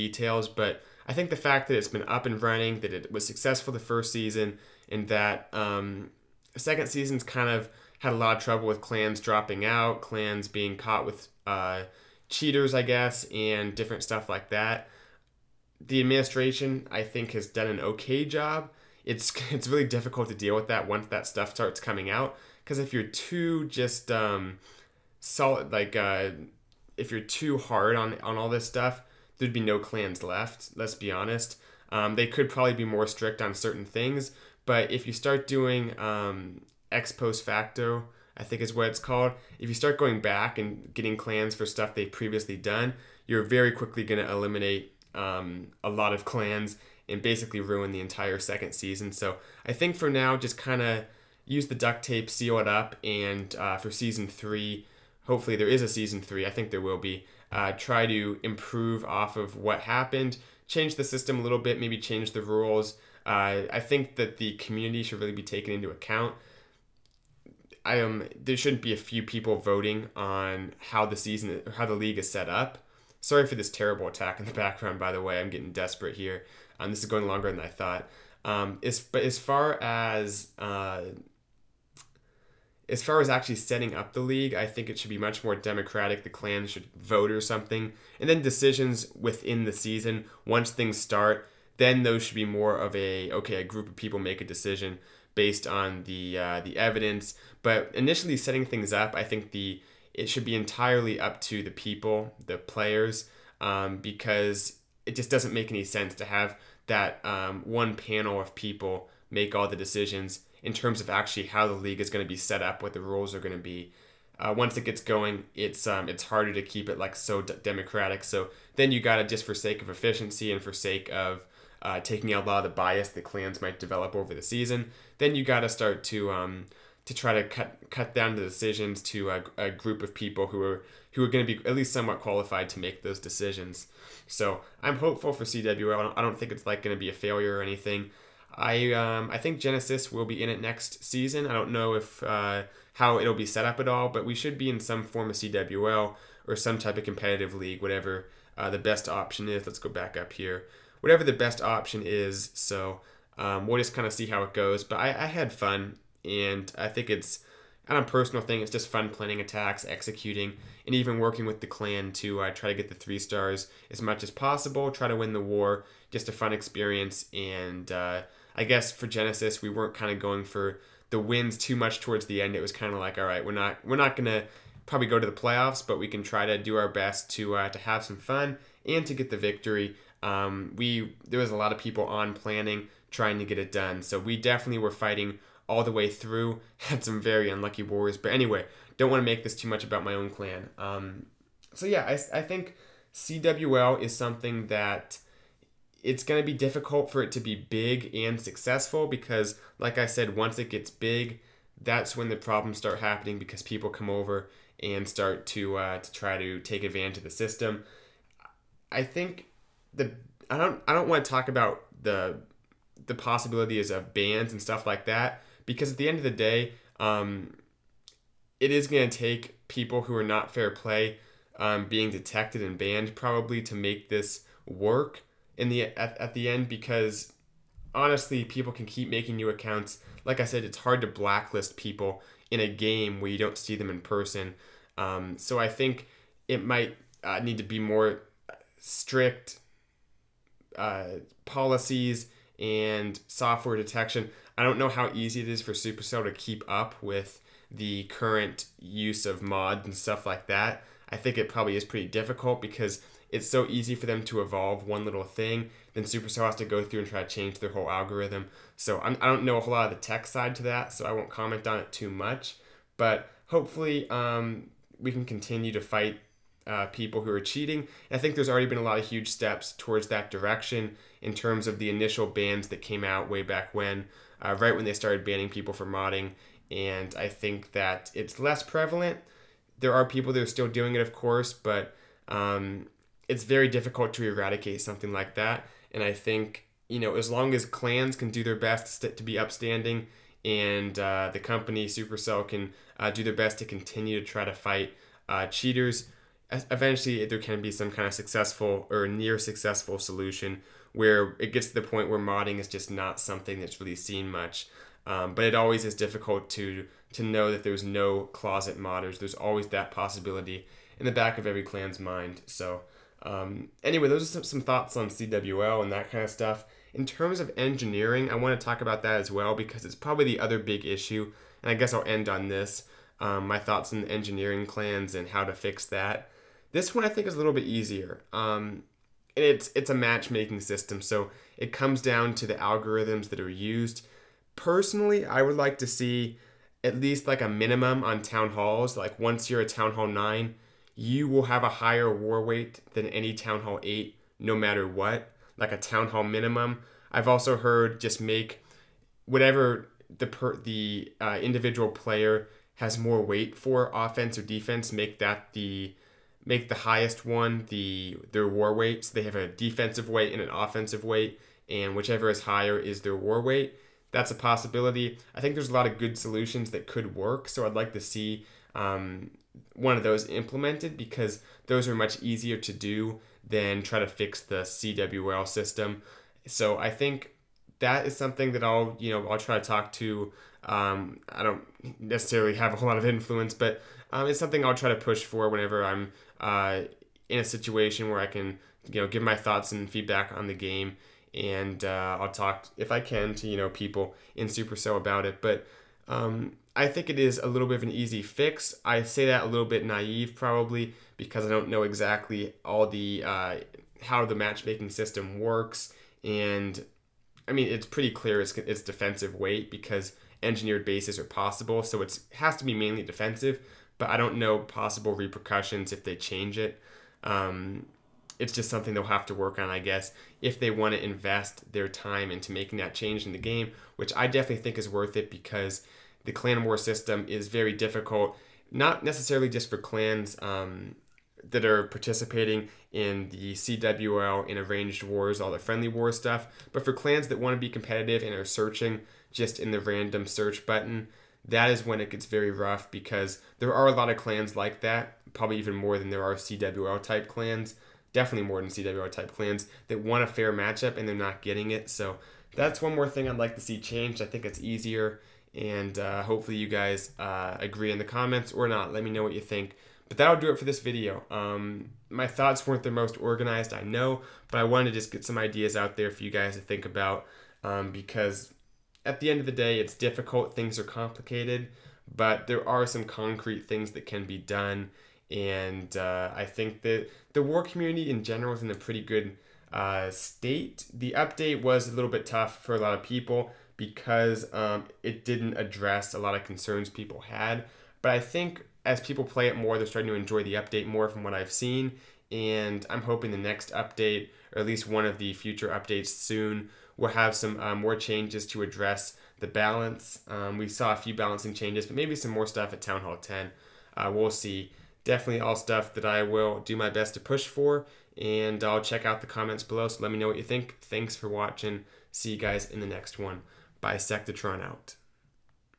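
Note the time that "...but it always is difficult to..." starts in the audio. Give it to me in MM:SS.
05:05.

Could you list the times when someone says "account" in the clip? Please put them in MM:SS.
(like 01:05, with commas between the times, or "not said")
01:05, 03:49.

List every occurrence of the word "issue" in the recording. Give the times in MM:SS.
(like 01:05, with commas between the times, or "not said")
05:20.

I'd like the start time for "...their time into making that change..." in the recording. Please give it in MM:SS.
07:01.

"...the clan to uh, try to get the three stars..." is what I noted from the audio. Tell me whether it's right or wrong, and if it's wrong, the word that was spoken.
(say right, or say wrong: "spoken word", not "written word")
right.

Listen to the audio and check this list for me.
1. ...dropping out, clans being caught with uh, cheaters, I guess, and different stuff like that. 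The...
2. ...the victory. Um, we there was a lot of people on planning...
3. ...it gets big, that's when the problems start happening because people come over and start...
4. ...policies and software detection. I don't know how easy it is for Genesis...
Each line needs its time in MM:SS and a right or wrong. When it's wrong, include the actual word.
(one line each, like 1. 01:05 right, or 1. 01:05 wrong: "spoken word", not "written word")
1. 00:09 right
2. 02:59 right
3. 03:20 right
4. 04:01 wrong: "Supercell", not "Genesis".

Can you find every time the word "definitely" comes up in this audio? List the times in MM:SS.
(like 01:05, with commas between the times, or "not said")
03:04, 07:04, 07:28, 08:25.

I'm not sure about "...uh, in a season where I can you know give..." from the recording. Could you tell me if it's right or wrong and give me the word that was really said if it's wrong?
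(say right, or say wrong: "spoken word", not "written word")
wrong: "situation", not "season".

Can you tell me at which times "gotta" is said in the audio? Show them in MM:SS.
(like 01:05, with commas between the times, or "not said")
01:58, 02:05.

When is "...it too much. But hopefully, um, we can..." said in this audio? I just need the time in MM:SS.
04:21.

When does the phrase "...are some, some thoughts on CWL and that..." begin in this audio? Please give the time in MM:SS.
05:14.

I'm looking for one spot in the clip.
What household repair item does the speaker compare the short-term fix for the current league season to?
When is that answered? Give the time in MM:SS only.
00:51.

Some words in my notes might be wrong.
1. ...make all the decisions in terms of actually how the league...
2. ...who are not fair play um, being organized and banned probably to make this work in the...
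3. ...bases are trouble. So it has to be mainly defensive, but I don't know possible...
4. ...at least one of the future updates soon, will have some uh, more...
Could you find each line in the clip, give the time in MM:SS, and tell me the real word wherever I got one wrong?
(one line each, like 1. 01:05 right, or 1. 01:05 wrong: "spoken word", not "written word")
1. 01:49 right
2. 03:40 wrong: "detected", not "organized"
3. 06:50 wrong: "possible", not "trouble"
4. 08:14 right.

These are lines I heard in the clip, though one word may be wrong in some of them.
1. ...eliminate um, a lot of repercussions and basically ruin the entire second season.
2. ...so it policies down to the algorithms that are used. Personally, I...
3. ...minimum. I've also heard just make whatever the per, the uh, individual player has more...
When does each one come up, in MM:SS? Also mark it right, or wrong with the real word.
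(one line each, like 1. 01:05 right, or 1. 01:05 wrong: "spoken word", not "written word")
1. 00:44 wrong: "clans", not "repercussions"
2. 05:31 wrong: "comes", not "policies"
3. 05:46 right.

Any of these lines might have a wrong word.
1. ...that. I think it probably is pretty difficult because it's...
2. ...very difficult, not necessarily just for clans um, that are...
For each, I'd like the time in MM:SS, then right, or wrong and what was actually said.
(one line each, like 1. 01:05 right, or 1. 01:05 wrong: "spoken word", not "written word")
1. 04:10 right
2. 07:07 right.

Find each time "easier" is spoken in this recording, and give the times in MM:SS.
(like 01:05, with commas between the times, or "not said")
05:27, 06:12, 07:34.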